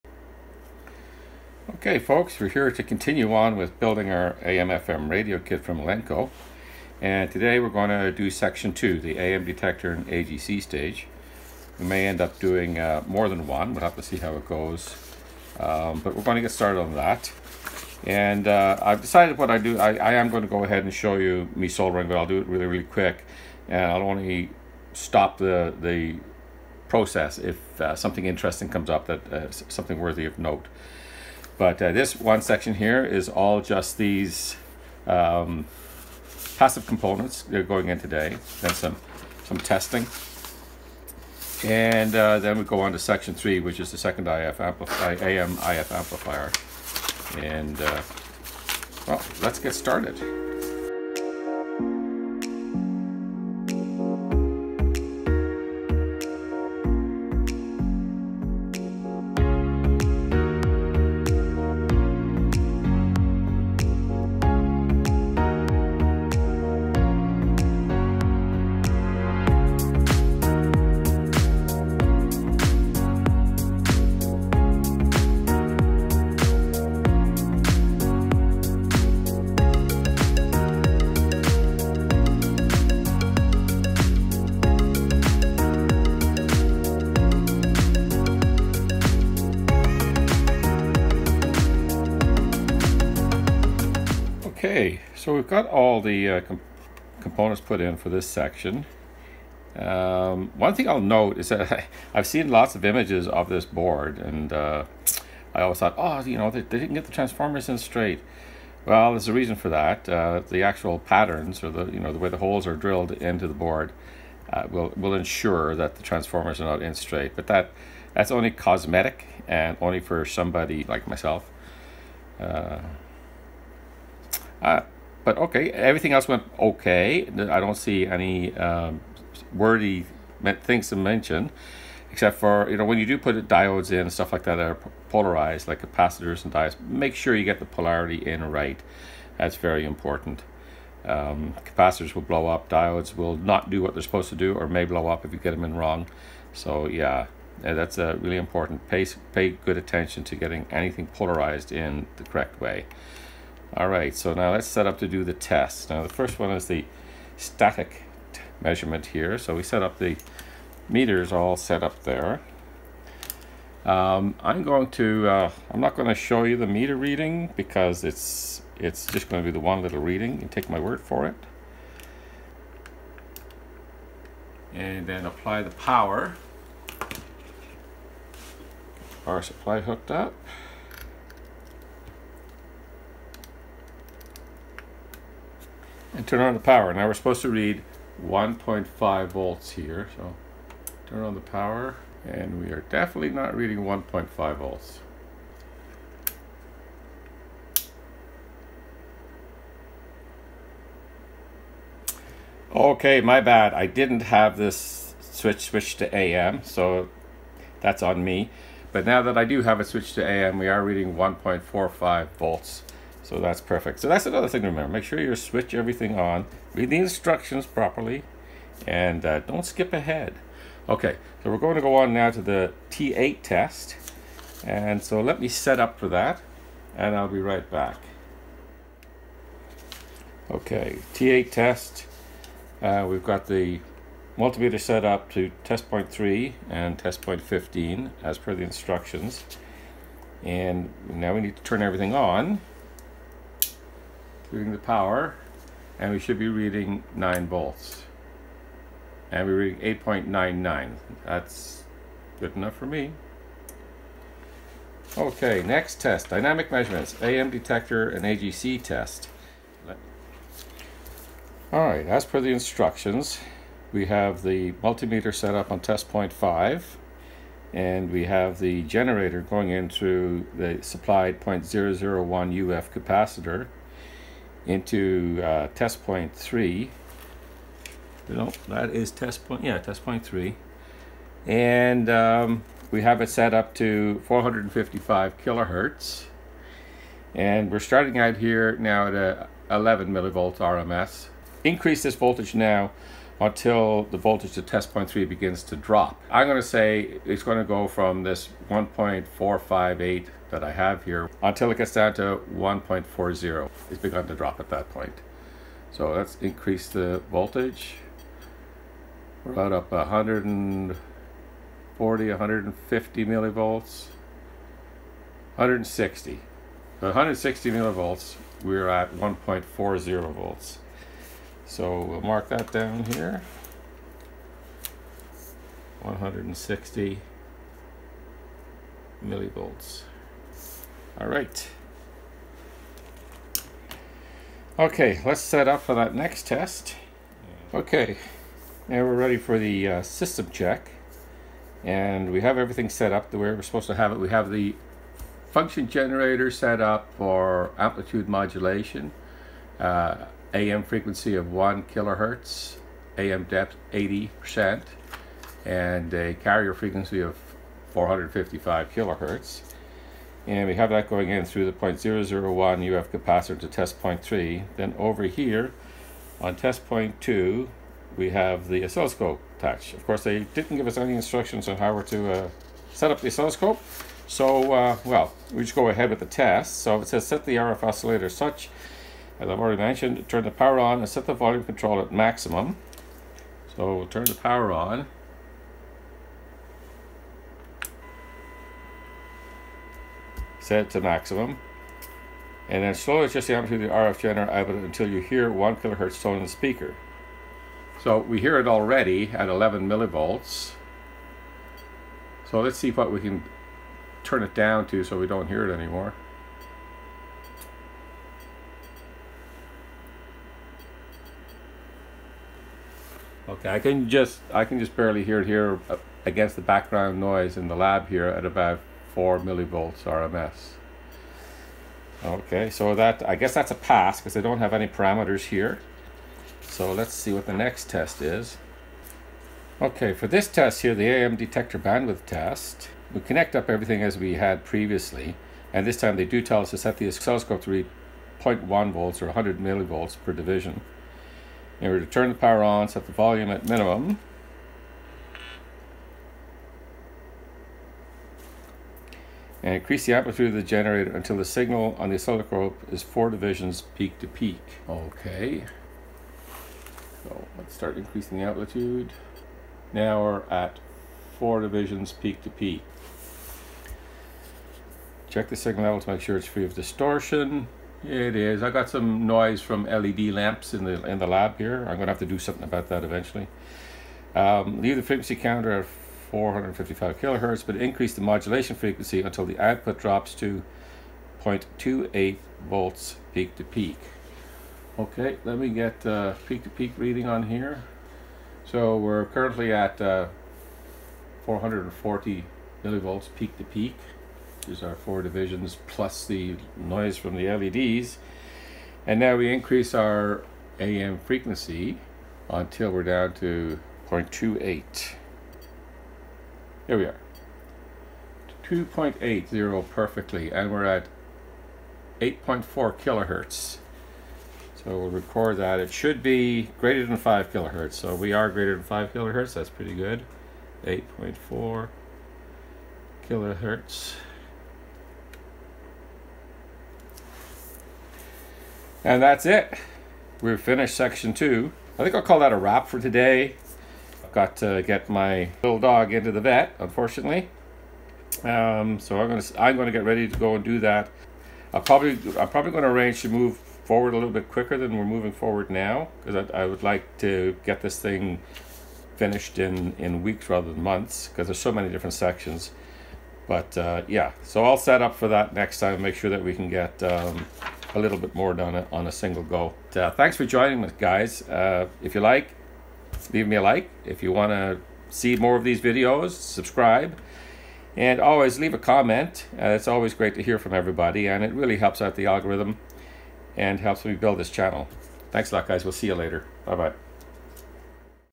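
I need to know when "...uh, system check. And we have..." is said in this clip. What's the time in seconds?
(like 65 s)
339 s.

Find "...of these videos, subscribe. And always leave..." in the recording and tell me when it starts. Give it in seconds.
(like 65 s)
565 s.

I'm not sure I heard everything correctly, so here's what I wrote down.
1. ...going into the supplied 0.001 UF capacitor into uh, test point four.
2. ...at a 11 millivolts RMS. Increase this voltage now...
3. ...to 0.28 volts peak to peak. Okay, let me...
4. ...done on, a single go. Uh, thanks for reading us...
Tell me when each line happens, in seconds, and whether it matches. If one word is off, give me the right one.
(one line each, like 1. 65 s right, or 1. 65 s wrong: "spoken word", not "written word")
1. 269 s wrong: "three", not "four"
2. 289 s right
3. 480 s right
4. 558 s wrong: "joining", not "reading".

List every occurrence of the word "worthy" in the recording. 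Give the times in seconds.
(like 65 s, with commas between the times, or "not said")
29 s, 129 s.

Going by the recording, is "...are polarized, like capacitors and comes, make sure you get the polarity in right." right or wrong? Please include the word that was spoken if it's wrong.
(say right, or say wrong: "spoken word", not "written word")
wrong: "diodes", not "comes".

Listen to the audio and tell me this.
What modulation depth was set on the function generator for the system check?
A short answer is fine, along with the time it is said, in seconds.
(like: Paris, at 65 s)
80%, at 353 s.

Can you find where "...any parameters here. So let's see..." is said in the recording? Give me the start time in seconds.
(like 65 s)
424 s.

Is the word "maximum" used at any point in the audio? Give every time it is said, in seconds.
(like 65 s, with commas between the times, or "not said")
382 s, 391 s.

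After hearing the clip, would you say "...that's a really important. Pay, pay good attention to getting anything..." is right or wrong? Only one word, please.
right.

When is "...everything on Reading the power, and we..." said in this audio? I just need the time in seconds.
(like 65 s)
241 s.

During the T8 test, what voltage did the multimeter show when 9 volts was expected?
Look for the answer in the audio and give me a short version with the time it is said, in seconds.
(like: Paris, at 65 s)
8.99, at 250 s.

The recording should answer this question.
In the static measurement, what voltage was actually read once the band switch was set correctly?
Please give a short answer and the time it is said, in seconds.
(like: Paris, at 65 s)
1.45 volts, at 211 s.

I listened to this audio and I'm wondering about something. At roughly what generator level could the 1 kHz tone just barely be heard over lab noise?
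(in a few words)
4 mV RMS.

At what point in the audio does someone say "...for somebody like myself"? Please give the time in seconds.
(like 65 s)
119 s.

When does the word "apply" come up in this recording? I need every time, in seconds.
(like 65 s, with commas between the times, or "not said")
175 s.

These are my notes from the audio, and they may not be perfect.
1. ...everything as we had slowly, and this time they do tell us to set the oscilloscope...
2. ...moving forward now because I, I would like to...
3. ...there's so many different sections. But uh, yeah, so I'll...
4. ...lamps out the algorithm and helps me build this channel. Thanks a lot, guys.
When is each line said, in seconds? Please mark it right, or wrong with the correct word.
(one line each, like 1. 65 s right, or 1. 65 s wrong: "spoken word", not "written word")
1. 433 s wrong: "previously", not "slowly"
2. 545 s right
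3. 551 s right
4. 571 s wrong: "helps", not "lamps".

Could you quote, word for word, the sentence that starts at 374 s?
So, uh, well, we just go ahead with the test.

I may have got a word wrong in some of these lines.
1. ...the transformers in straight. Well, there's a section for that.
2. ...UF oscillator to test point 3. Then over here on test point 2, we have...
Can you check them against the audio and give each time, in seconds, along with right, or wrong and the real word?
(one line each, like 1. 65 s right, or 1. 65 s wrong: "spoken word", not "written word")
1. 107 s wrong: "reason", not "section"
2. 362 s wrong: "capacitor", not "oscillator".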